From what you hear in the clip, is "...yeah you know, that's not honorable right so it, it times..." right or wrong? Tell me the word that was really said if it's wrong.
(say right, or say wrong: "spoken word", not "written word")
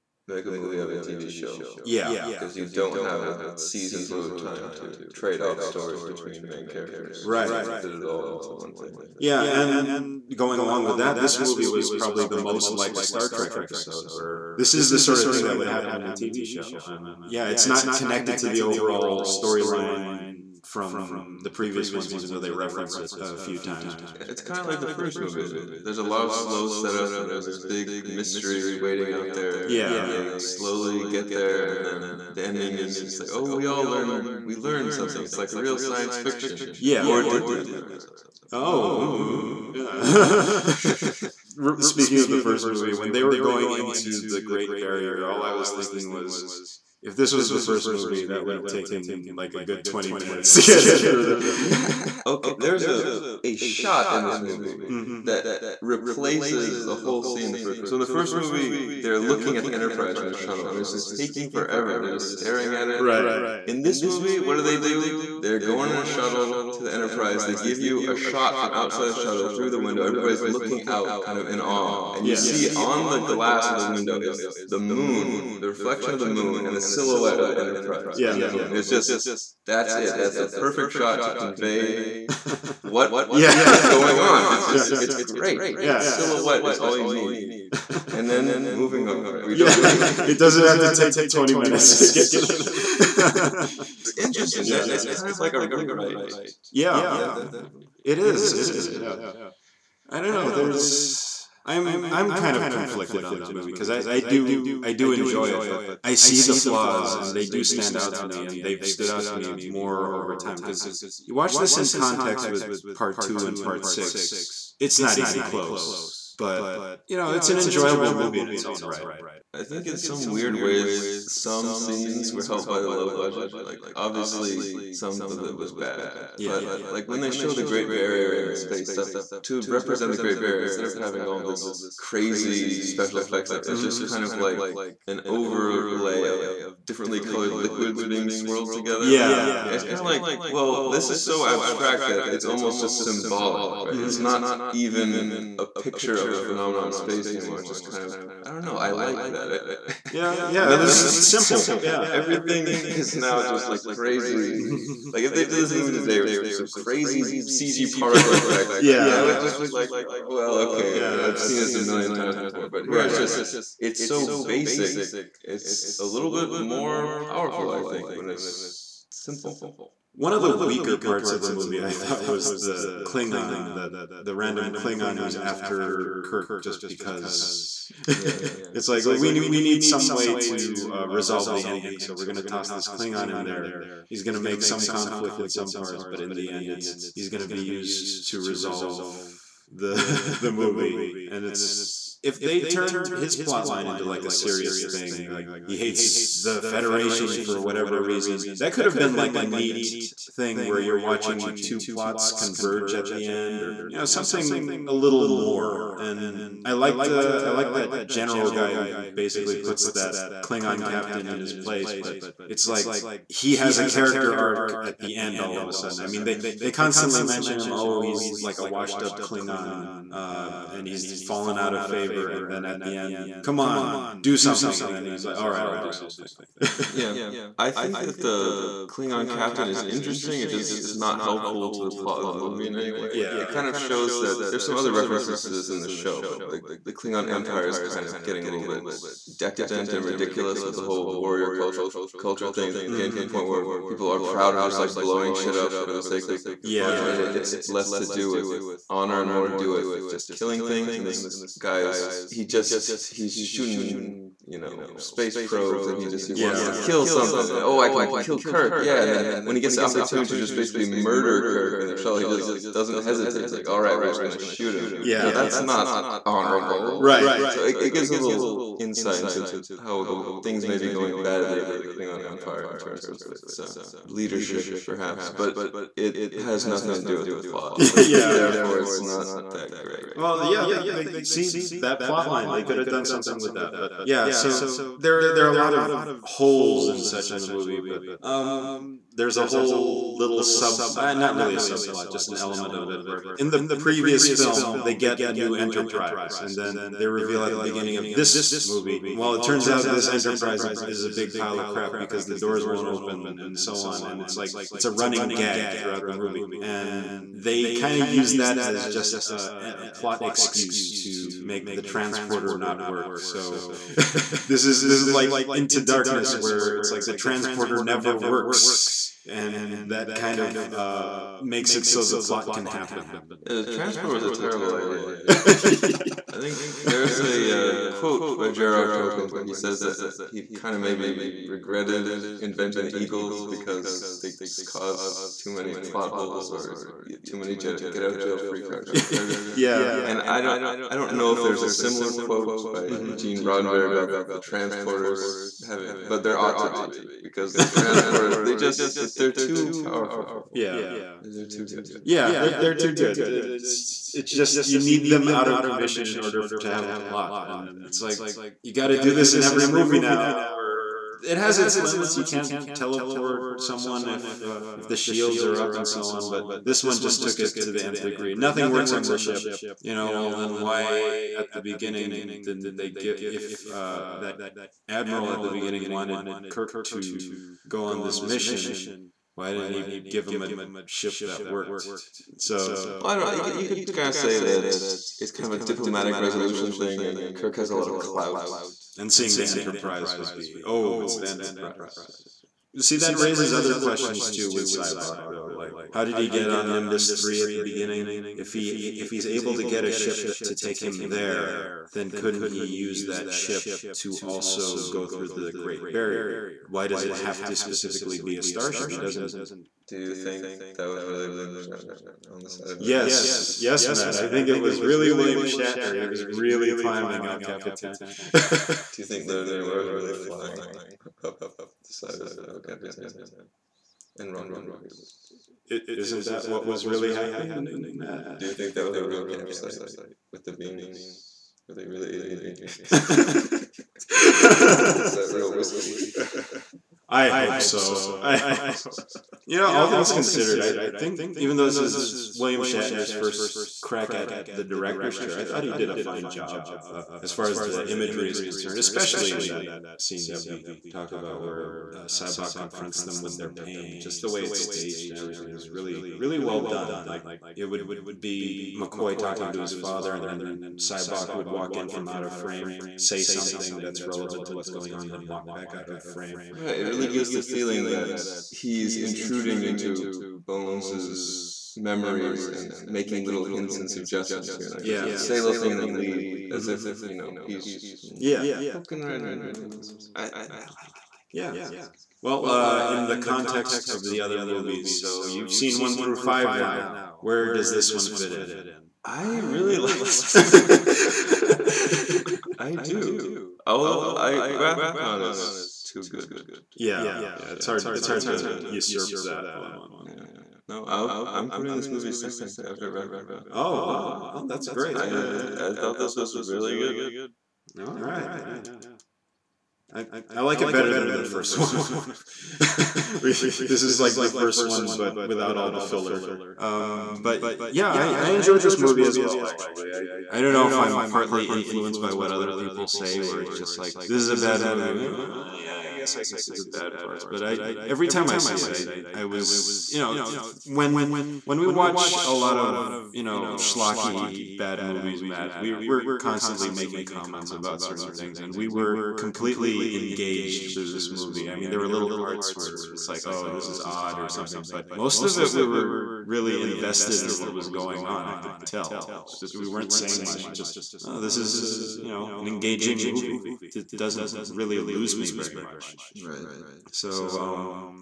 wrong: "gives", not "times".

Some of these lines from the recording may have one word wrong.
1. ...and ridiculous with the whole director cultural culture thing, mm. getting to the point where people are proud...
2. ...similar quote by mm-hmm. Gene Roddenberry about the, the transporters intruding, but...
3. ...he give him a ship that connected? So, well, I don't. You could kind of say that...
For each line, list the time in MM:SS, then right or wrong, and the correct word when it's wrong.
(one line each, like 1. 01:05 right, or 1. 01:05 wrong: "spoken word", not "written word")
1. 03:59 wrong: "warrior", not "director"
2. 05:41 wrong: "having", not "intruding"
3. 06:19 wrong: "worked", not "connected".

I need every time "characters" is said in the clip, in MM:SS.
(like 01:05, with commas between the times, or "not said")
00:06, 03:33.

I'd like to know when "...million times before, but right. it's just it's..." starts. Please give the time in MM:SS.
02:41.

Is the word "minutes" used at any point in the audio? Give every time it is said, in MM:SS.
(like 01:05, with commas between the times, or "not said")
00:50, 01:31.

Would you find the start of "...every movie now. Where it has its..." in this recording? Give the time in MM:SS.
05:59.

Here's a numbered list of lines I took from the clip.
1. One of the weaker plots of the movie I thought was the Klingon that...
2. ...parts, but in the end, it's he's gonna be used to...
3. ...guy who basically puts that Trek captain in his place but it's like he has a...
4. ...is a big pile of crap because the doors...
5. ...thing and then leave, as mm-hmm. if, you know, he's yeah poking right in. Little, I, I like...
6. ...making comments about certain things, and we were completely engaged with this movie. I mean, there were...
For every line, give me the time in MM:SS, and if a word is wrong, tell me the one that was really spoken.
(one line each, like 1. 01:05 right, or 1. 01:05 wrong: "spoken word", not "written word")
1. 02:50 wrong: "parts", not "plots"
2. 03:05 right
3. 03:28 wrong: "Klingon", not "Trek"
4. 05:00 right
5. 07:55 right
6. 08:56 right.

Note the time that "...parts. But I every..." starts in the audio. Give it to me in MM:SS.
08:46.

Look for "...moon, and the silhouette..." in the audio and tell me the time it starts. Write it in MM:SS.
01:16.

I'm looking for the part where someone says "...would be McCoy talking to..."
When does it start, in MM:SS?
07:37.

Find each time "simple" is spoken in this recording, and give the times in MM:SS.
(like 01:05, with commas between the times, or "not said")
02:31, 02:49.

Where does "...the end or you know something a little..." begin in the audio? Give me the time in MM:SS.
03:23.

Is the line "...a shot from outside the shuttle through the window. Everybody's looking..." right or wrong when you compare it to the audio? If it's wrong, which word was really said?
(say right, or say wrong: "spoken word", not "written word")
right.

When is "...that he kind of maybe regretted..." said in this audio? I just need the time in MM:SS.
05:29.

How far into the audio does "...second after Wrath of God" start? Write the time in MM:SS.
08:22.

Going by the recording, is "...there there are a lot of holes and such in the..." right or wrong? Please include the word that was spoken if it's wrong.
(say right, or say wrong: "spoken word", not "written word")
right.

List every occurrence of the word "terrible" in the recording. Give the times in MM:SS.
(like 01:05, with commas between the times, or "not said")
05:24.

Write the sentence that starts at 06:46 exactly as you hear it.
why does it have to specifically be a starship?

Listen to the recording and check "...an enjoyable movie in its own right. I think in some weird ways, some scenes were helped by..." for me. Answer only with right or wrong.
right.